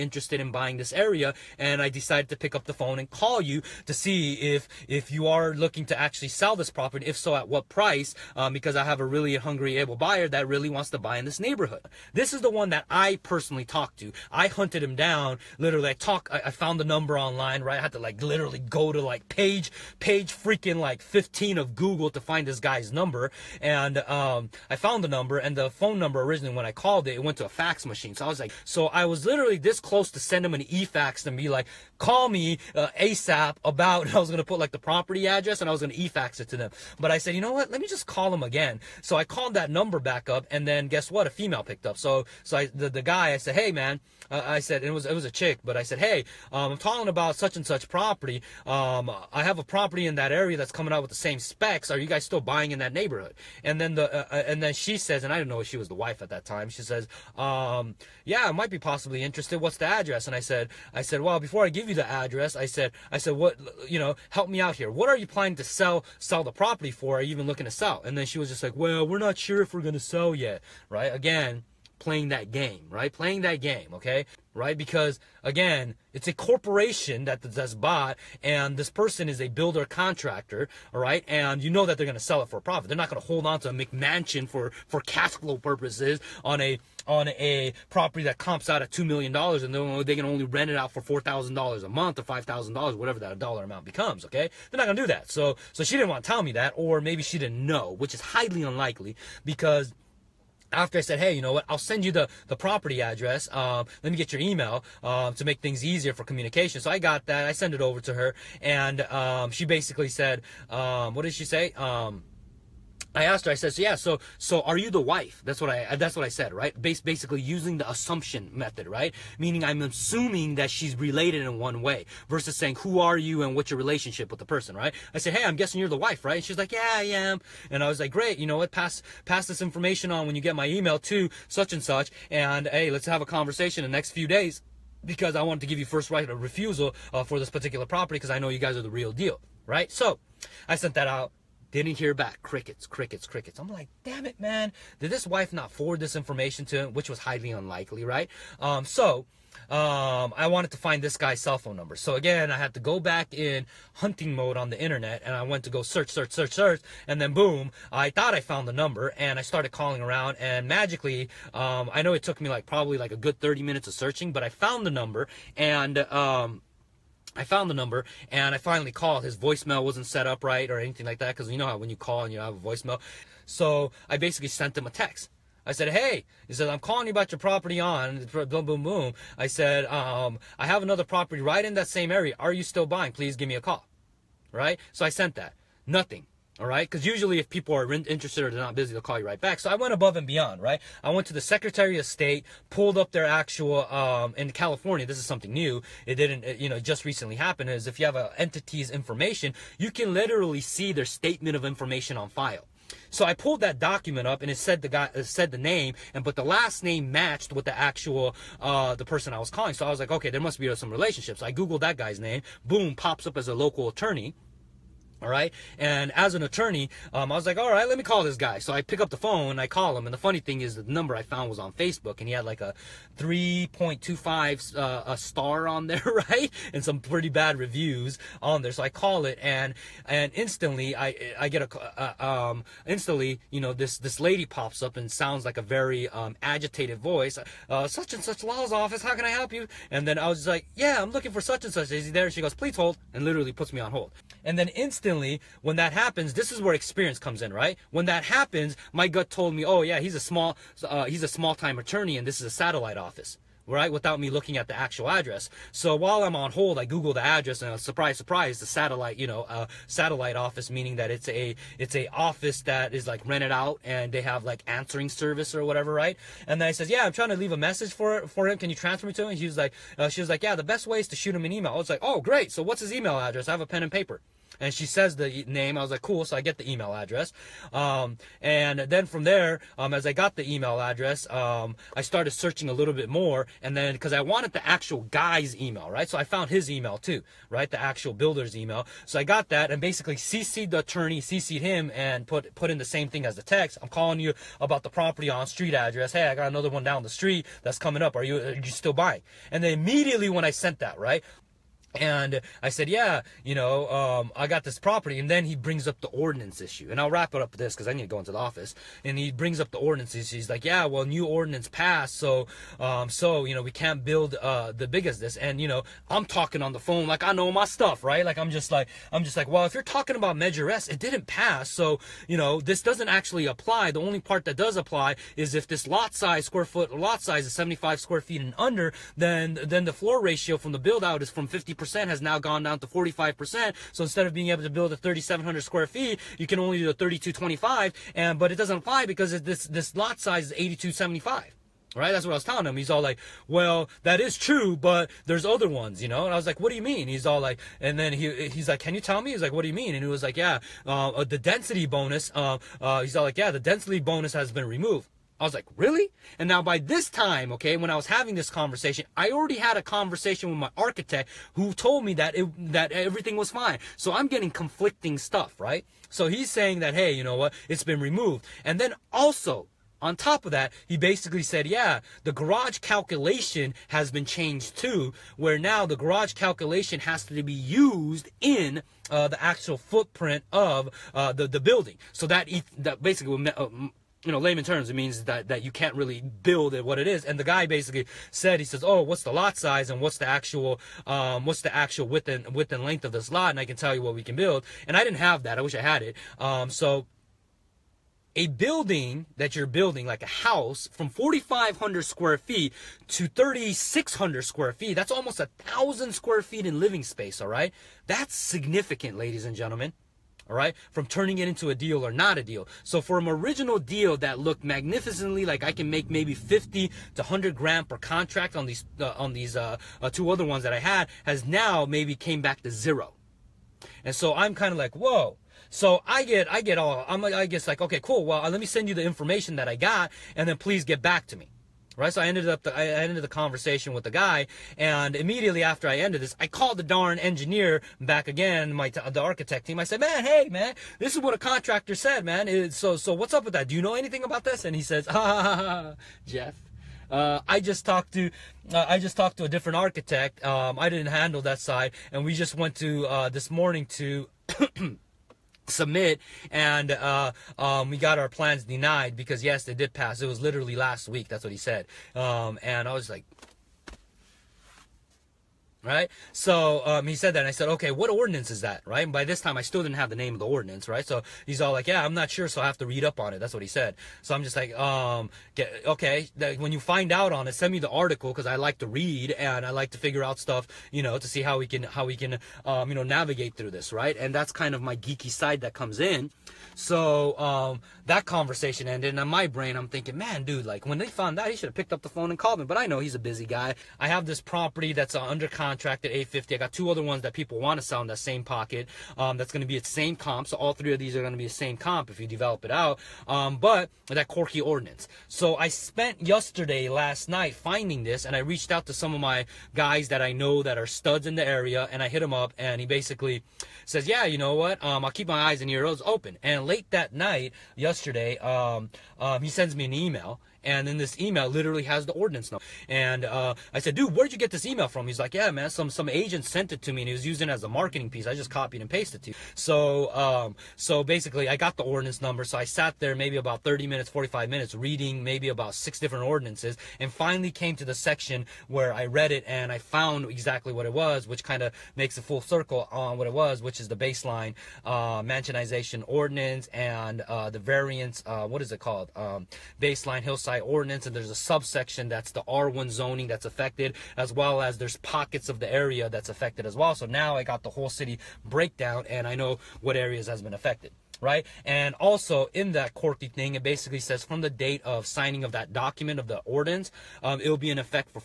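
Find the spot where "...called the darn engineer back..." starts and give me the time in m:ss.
7:16.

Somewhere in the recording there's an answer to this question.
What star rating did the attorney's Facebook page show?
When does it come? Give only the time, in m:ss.
3:43.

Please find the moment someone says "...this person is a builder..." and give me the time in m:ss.
1:18.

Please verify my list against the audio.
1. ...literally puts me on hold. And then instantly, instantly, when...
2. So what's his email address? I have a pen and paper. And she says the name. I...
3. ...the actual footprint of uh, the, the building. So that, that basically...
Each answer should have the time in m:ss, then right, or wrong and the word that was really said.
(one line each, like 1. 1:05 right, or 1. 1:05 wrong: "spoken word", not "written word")
1. 4:03 right
2. 4:32 right
3. 6:19 right.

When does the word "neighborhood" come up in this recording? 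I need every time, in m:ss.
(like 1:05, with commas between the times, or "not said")
0:11, 0:52.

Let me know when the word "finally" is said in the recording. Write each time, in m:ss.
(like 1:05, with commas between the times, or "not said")
2:48, 8:57.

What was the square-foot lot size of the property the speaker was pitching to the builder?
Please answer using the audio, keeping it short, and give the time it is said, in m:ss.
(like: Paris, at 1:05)
8,275, at 5:40.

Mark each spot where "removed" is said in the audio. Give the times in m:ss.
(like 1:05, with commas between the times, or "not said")
5:54, 6:08.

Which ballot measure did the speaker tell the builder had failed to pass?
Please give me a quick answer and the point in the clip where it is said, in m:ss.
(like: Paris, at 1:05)
Measure S, at 5:20.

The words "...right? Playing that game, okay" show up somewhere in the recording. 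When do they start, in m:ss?
1:12.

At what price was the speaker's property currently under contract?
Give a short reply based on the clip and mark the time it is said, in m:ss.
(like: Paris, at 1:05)
850, at 8:16.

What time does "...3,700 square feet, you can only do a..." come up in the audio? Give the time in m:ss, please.
5:34.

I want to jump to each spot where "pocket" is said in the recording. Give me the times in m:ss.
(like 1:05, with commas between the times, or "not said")
8:18, 9:14.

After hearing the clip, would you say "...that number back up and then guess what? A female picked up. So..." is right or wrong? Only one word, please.
right.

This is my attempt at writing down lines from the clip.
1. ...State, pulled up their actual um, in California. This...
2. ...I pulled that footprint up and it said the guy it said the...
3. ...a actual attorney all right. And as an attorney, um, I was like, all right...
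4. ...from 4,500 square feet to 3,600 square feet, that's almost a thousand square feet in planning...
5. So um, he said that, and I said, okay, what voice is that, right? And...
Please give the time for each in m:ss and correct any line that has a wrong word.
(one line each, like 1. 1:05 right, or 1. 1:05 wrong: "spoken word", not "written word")
1. 3:12 right
2. 3:23 wrong: "document", not "footprint"
3. 3:33 wrong: "local", not "actual"
4. 6:40 wrong: "living", not "planning"
5. 7:46 wrong: "ordinance", not "voice".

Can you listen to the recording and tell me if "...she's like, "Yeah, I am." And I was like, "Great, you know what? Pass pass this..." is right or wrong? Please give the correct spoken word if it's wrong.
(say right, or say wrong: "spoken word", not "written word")
right.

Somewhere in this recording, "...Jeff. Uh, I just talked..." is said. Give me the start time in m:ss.
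7:26.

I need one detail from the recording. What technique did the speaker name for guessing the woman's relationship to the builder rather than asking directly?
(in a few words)
assumption method.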